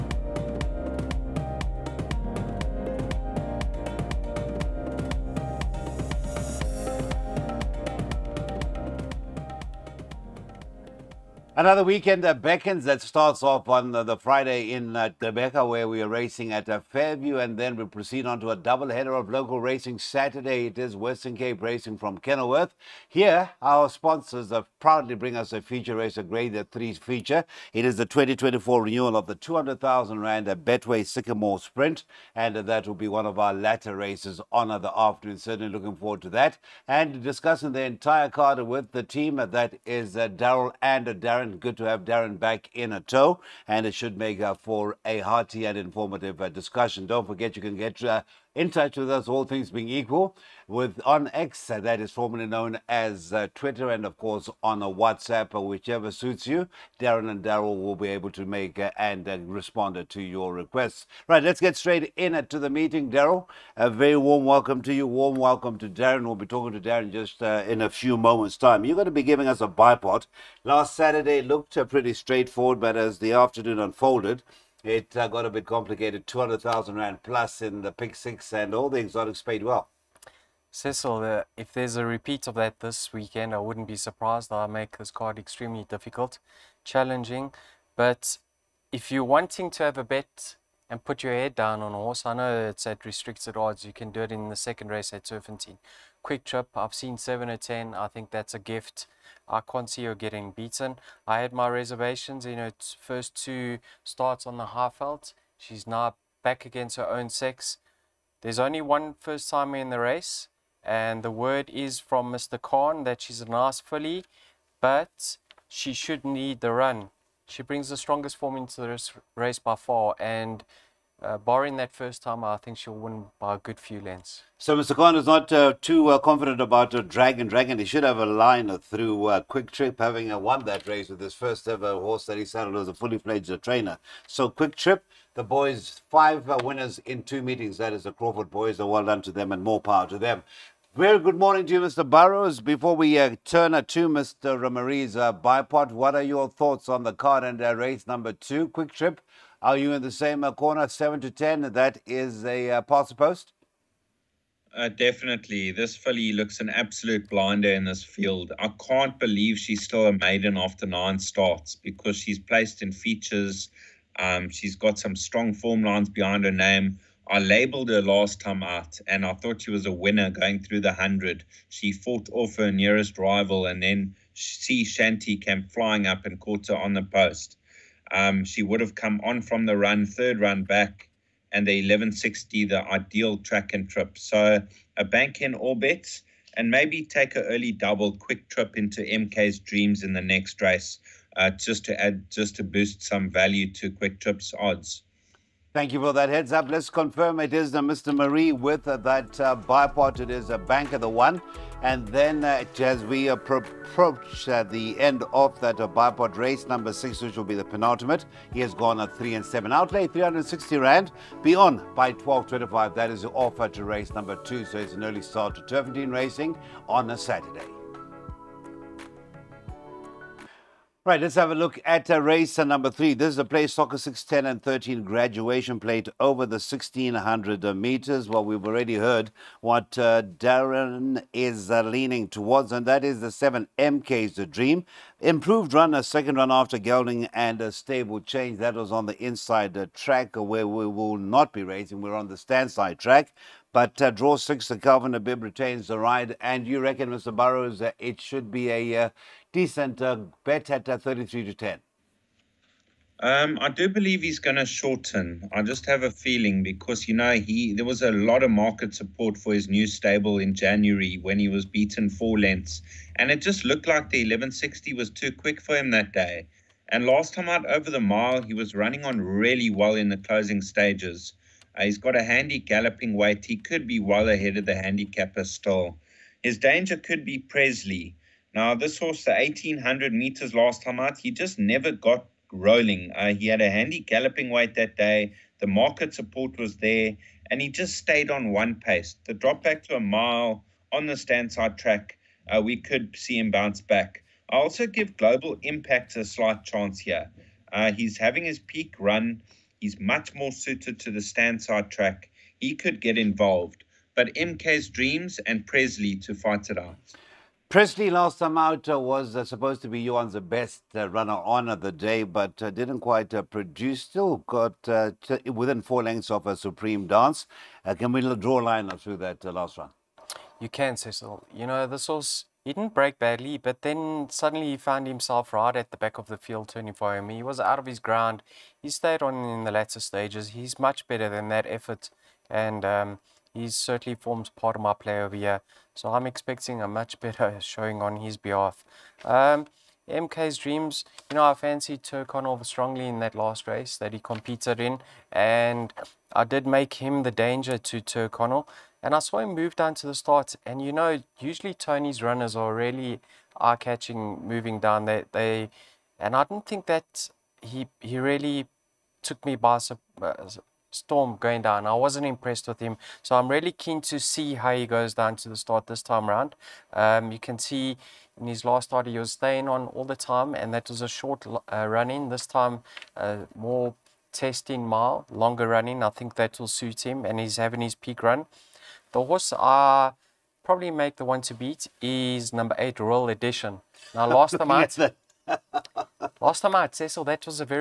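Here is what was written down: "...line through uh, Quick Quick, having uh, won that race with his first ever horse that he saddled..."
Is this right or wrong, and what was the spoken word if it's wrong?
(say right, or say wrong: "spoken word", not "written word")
wrong: "Trip", not "Quick".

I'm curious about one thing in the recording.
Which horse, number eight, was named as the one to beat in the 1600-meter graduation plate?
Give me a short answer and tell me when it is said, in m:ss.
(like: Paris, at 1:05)
Royal Edition, at 6:22.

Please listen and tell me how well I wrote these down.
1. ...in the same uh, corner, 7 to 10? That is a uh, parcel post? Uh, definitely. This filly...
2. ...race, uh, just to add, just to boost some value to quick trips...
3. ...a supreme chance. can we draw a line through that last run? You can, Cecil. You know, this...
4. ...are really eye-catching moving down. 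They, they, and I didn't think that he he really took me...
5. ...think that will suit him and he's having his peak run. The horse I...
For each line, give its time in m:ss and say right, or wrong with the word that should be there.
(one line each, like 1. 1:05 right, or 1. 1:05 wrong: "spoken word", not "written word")
1. 2:29 right
2. 3:10 right
3. 5:16 wrong: "dance", not "chance"
4. 5:52 right
5. 6:16 right.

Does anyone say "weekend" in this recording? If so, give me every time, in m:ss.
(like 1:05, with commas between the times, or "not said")
0:11, 1:23.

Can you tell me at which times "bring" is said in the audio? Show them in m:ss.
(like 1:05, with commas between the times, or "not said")
0:25, 1:57.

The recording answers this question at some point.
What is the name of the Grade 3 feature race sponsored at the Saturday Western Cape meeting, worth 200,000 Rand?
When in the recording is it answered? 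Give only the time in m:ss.
0:30.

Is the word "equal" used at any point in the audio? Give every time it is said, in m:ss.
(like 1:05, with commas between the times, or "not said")
0:49.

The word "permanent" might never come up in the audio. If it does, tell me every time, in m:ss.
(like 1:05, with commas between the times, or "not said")
not said.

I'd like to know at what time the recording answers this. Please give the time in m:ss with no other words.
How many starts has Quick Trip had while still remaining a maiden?
2:40.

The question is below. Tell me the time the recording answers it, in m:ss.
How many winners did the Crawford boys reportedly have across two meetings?
2:16.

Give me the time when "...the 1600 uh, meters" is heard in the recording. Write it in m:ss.
3:46.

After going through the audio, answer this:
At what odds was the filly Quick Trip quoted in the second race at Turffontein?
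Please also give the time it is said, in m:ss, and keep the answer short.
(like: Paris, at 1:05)
7 to 10, at 1:37.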